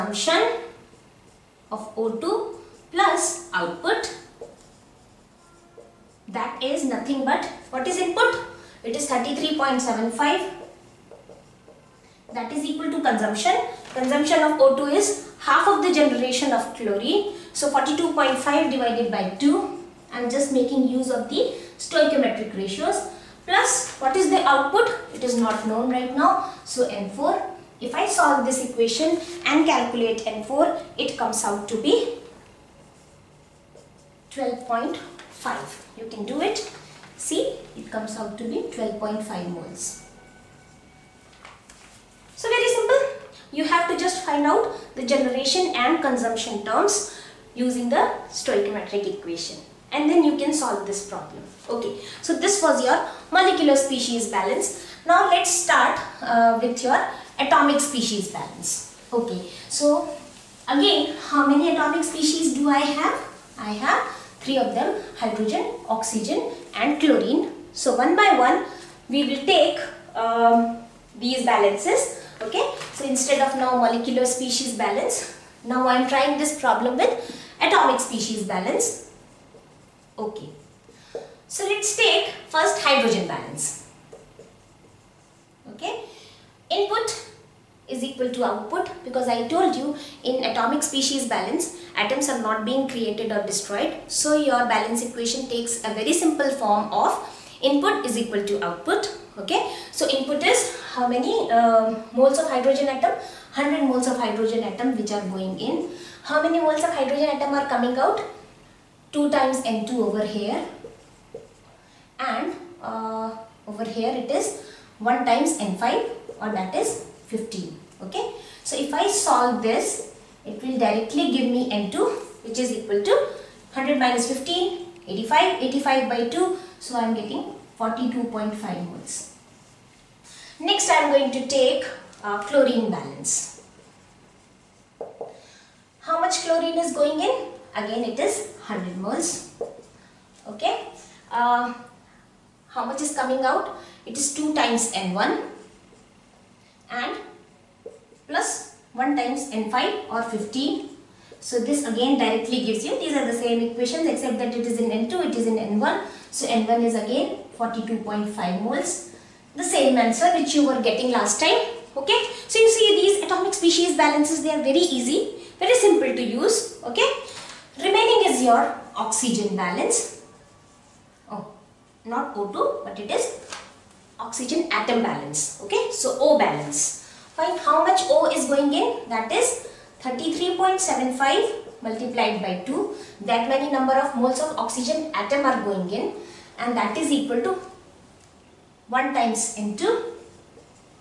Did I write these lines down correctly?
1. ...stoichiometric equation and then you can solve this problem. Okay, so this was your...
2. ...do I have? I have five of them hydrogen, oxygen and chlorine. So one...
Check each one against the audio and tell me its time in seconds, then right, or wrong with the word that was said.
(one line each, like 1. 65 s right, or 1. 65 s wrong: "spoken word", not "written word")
1. 48 s right
2. 62 s wrong: "three", not "five".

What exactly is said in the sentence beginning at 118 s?
So if I solve this, it will directly give me N2 which is equal to 100 minus 15, 85, 85 by 2.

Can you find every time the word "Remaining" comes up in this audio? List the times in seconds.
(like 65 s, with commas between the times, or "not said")
167 s.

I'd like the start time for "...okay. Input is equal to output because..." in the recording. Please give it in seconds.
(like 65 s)
85 s.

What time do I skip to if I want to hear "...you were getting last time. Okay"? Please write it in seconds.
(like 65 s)
160 s.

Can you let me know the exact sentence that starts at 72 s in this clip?
So instead of now molecular species balance now I am trying this problem with atomic species balance okay.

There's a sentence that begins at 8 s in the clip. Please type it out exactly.
It is 33.75 that is equal to consumption.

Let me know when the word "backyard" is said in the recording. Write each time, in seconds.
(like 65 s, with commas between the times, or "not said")
not said.